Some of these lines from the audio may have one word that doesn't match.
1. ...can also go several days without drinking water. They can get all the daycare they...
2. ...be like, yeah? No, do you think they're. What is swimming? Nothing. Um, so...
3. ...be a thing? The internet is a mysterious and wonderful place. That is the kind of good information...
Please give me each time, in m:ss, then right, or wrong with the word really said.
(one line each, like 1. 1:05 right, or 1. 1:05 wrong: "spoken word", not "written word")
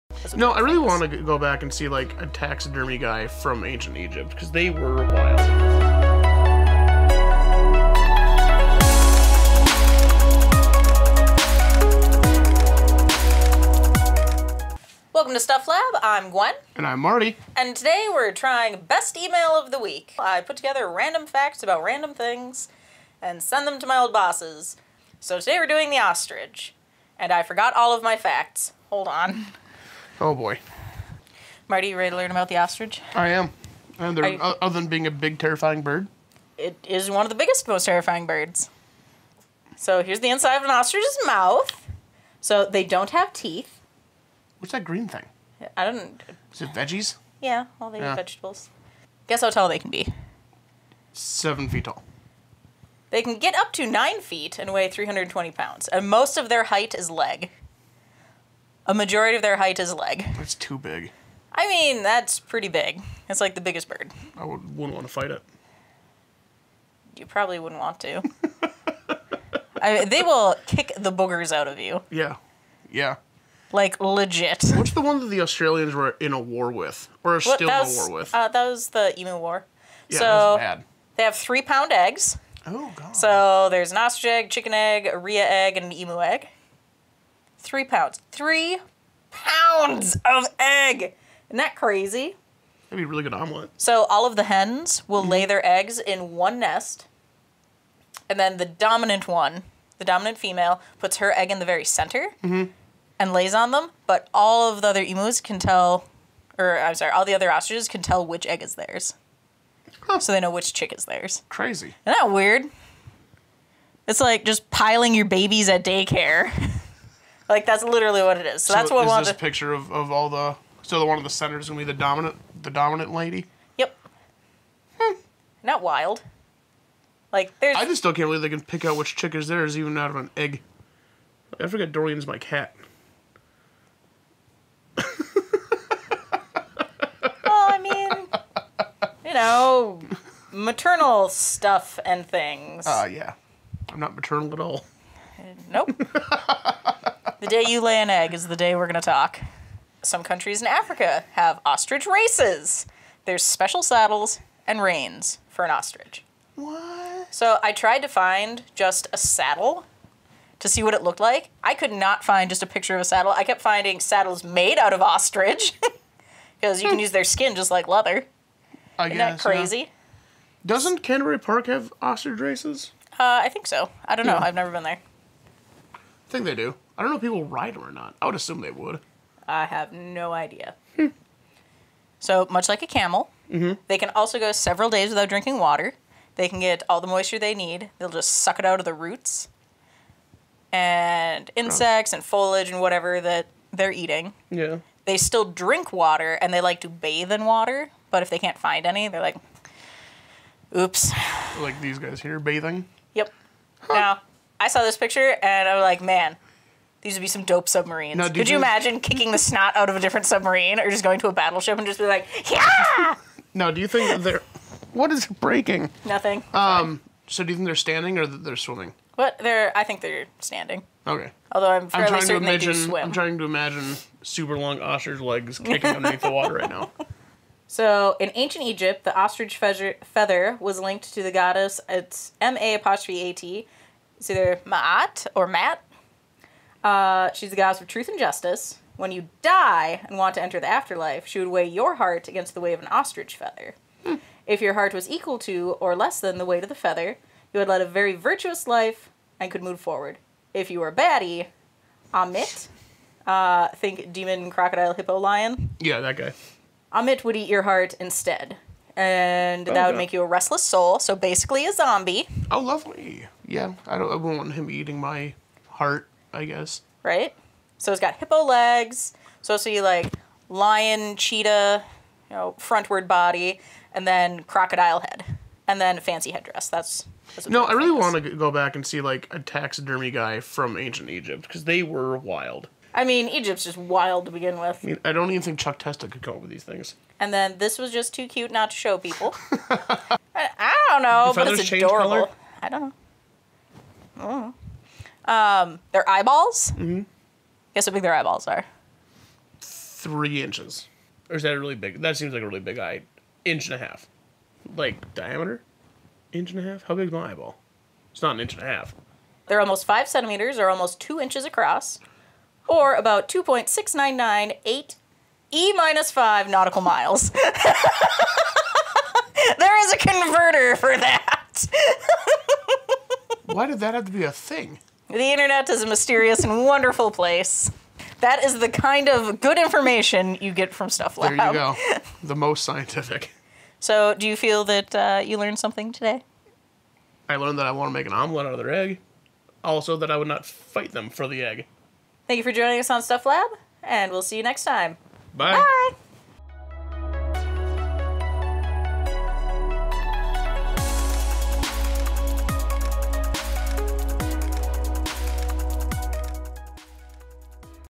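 1. 3:03 wrong: "moisture", not "daycare"
2. 3:31 wrong: "breaking", not "swimming"
3. 5:24 right.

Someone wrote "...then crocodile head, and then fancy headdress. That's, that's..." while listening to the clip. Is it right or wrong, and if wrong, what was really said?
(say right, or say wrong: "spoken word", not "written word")
right.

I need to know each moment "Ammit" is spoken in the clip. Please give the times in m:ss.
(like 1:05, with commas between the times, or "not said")
4:12, 4:16.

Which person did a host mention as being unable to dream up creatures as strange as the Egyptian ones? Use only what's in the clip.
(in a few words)
Chuck Testa.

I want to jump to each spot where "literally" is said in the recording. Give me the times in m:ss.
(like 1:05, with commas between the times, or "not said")
1:57.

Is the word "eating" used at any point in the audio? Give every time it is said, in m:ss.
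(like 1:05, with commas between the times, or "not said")
3:13, 4:24.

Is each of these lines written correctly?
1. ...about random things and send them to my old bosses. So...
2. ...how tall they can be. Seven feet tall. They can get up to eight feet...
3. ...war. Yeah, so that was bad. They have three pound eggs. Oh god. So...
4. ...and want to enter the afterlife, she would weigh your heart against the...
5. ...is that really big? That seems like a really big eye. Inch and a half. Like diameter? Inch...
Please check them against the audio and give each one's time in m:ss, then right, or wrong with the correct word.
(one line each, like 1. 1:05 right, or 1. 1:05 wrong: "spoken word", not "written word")
1. 0:21 right
2. 0:49 wrong: "nine", not "eight"
3. 1:19 right
4. 4:00 right
5. 5:01 right.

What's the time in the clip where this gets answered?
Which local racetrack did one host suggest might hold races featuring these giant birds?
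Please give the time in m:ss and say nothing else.
2:51.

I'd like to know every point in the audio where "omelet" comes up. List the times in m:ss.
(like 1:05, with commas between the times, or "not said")
1:33, 5:38.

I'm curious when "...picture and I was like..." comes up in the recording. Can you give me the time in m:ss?
3:24.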